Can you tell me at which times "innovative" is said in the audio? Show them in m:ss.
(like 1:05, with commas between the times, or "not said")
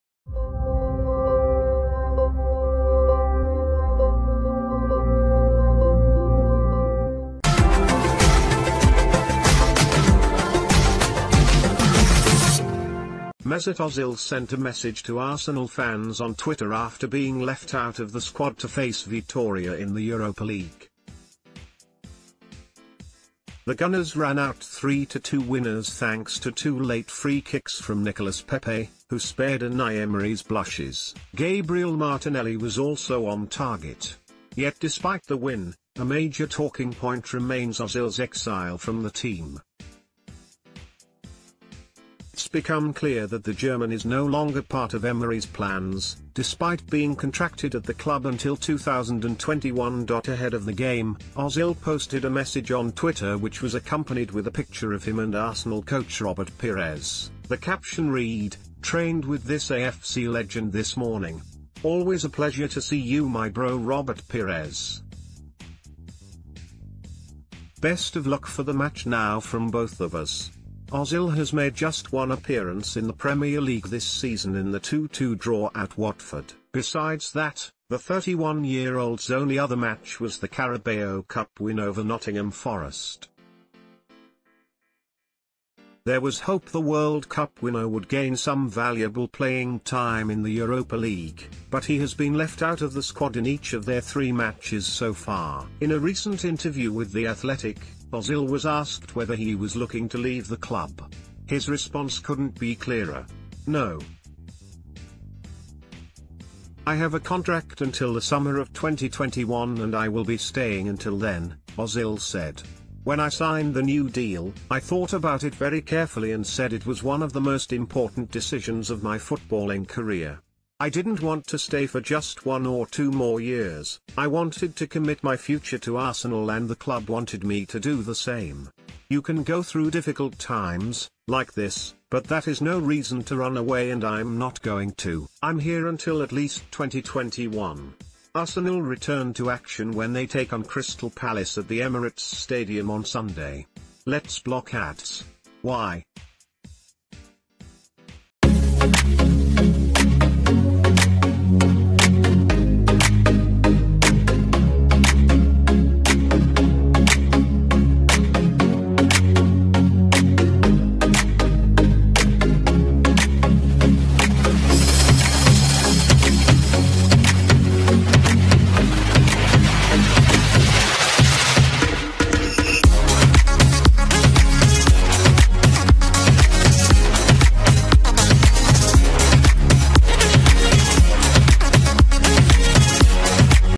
not said.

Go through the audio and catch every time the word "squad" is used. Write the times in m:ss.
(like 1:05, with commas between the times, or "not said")
0:18, 1:33.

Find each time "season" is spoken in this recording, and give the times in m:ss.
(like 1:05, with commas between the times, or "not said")
1:14.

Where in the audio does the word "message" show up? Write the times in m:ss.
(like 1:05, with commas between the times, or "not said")
0:14, 0:52.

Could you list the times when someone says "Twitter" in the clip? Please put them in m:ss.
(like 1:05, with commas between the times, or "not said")
0:16, 0:52.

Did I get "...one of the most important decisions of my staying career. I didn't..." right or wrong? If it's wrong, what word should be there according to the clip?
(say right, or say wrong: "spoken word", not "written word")
wrong: "footballing", not "staying".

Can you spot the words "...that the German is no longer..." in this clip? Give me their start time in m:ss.
0:43.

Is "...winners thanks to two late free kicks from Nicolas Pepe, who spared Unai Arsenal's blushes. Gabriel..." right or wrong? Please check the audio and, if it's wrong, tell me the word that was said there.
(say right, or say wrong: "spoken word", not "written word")
wrong: "Emery", not "Arsenal".